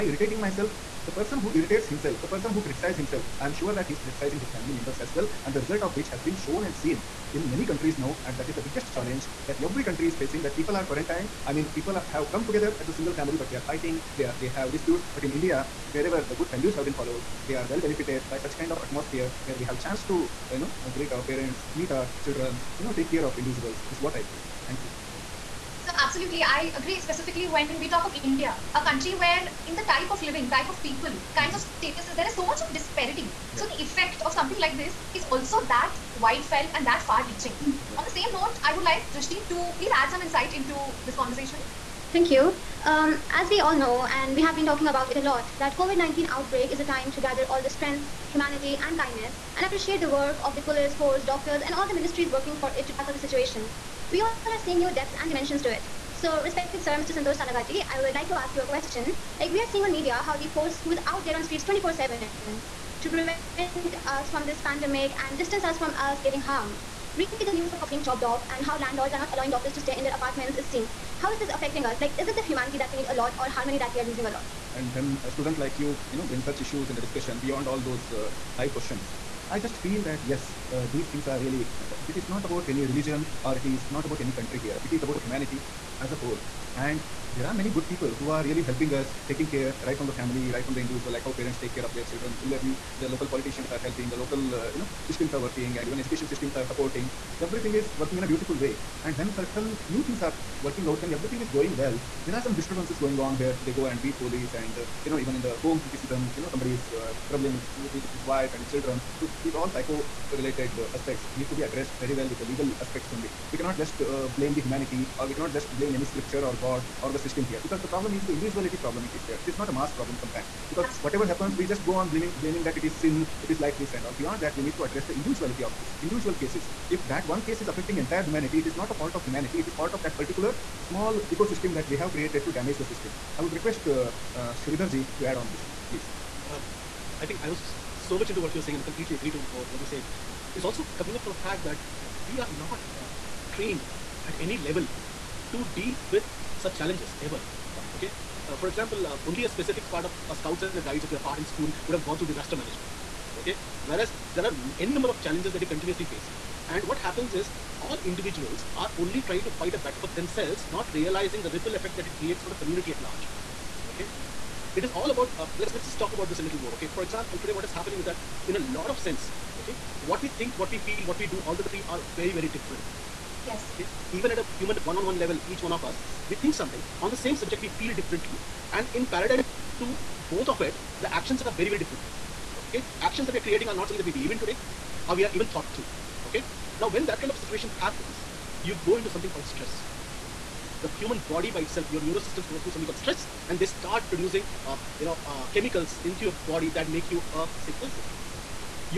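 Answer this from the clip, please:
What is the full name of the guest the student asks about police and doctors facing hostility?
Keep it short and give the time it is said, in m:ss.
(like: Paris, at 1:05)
Santosh Talaghatti, at 0:56.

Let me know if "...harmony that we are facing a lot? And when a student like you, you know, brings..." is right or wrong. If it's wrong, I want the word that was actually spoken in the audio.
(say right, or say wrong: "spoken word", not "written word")
wrong: "losing", not "facing".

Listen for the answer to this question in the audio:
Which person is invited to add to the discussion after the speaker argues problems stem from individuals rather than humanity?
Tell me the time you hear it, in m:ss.
2:14.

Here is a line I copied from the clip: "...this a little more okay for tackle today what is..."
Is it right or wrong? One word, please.
wrong.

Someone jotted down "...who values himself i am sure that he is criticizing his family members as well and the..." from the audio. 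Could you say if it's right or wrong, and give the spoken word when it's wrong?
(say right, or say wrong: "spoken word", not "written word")
wrong: "criticizes", not "values".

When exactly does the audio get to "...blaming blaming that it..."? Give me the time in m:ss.
2:02.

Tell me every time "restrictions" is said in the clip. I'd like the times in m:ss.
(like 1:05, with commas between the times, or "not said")
not said.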